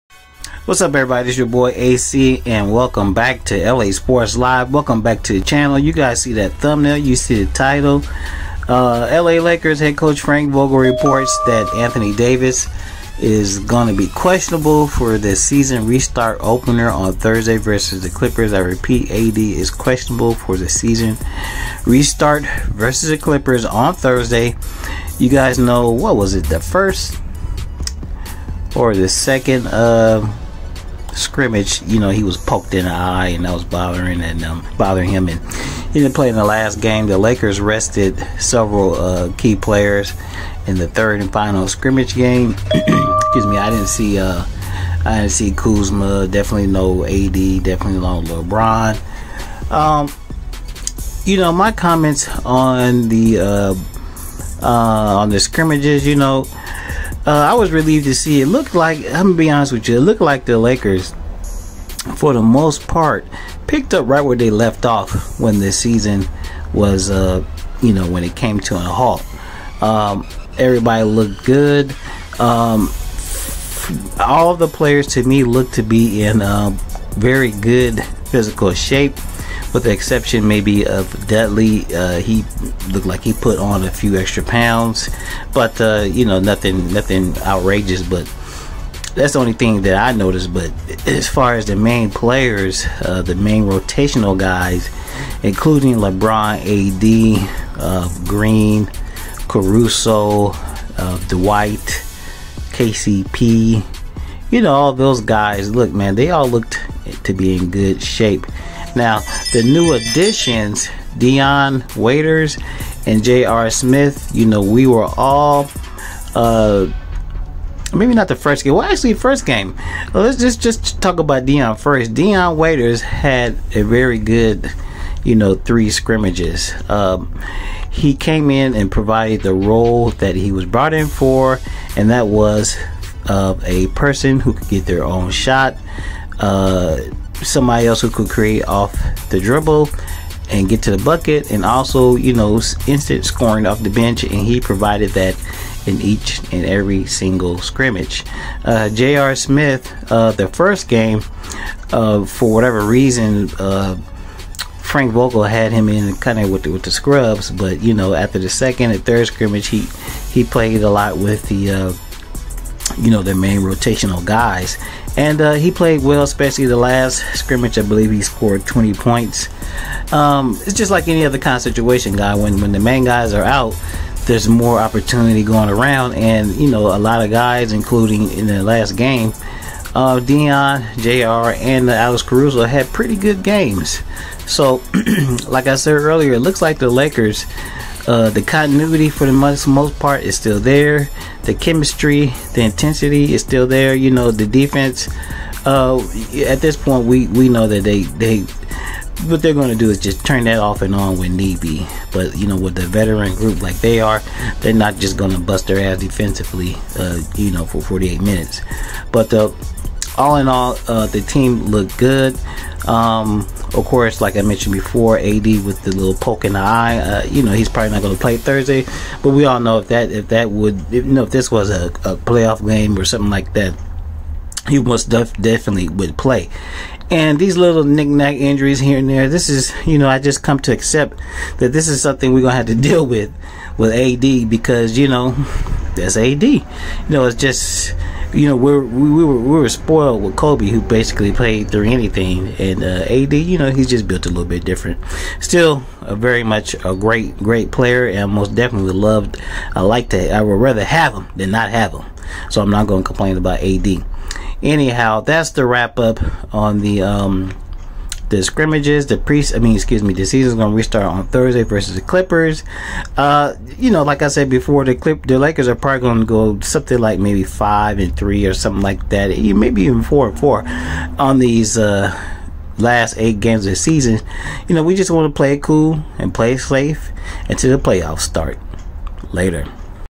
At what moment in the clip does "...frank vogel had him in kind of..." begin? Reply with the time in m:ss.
2:34.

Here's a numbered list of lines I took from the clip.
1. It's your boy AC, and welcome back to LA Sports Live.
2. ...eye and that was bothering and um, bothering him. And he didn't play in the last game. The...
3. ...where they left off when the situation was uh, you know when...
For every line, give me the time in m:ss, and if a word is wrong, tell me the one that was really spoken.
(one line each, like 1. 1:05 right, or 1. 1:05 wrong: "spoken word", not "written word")
1. 0:01 right
2. 0:32 right
3. 1:04 wrong: "season", not "situation".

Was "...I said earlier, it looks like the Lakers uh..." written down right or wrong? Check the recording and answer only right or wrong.
right.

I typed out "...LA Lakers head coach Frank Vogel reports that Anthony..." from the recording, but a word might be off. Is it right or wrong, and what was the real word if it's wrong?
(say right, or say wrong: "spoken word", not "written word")
right.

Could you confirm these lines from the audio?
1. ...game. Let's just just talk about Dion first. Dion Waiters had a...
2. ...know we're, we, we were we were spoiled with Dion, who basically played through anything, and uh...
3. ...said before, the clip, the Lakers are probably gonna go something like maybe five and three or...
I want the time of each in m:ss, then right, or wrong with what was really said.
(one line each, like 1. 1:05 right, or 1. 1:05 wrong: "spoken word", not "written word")
1. 1:59 right
2. 3:58 wrong: "Kobe", not "Dion"
3. 4:24 right.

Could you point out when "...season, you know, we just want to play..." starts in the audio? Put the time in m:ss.
4:33.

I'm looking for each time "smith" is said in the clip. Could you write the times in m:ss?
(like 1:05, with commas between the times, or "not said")
1:53, 2:29.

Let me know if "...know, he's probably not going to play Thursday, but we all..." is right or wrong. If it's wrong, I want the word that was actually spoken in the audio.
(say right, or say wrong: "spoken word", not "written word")
right.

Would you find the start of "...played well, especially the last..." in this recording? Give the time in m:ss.
2:45.